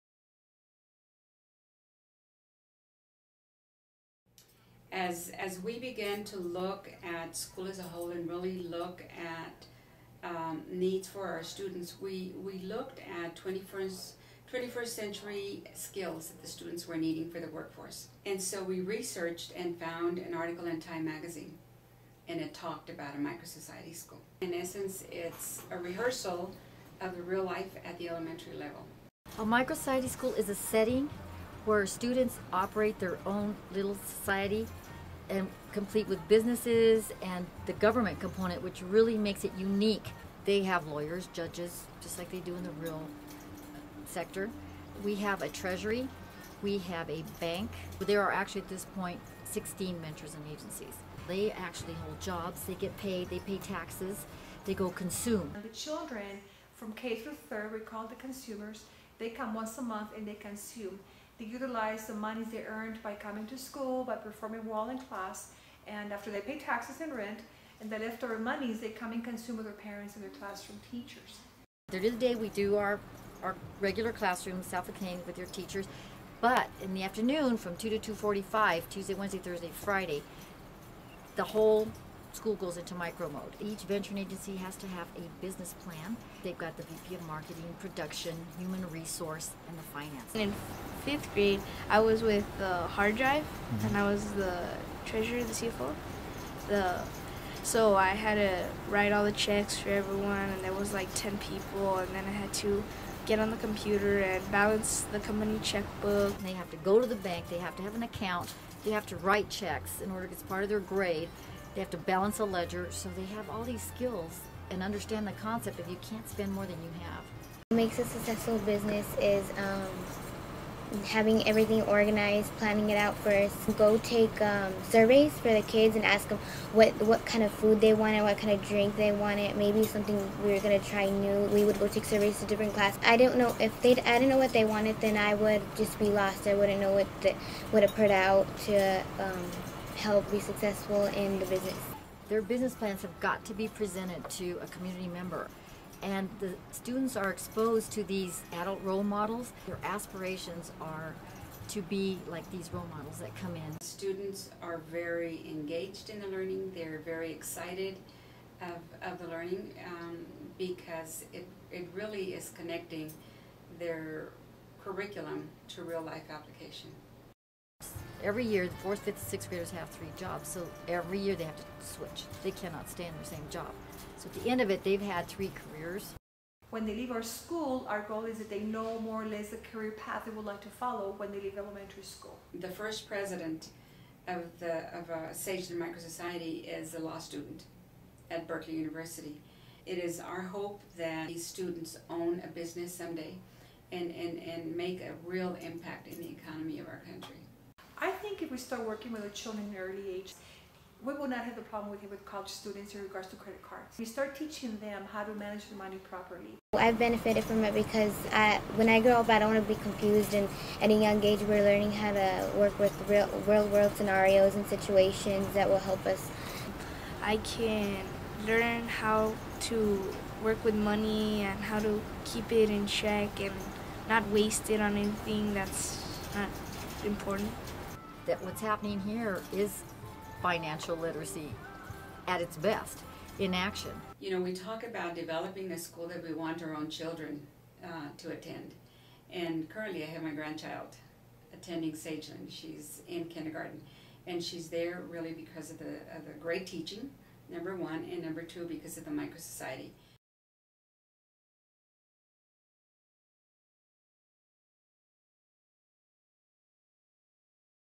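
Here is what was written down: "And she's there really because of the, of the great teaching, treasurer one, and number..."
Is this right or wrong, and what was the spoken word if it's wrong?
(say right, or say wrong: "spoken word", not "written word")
wrong: "number", not "treasurer".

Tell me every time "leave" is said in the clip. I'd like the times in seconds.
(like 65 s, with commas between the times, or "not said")
176 s, 181 s.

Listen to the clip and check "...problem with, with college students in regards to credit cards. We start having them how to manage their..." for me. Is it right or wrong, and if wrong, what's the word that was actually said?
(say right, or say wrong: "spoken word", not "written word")
wrong: "teaching", not "having".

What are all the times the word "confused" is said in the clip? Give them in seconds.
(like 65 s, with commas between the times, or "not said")
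209 s.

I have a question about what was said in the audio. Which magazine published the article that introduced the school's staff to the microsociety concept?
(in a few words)
Time.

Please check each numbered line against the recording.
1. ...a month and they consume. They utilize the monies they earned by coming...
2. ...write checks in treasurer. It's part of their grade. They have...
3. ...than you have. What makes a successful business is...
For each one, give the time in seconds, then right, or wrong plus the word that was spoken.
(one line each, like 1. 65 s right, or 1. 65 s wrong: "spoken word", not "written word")
1. 59 s right
2. 109 s wrong: "order", not "treasurer"
3. 116 s right.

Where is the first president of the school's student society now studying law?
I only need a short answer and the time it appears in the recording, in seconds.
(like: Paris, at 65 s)
Berkeley University, at 188 s.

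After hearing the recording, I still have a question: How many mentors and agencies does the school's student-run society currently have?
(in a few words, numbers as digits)
16.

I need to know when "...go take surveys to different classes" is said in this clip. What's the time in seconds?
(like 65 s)
131 s.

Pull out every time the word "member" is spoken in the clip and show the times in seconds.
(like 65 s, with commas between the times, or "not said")
145 s.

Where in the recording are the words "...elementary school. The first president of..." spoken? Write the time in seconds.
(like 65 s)
181 s.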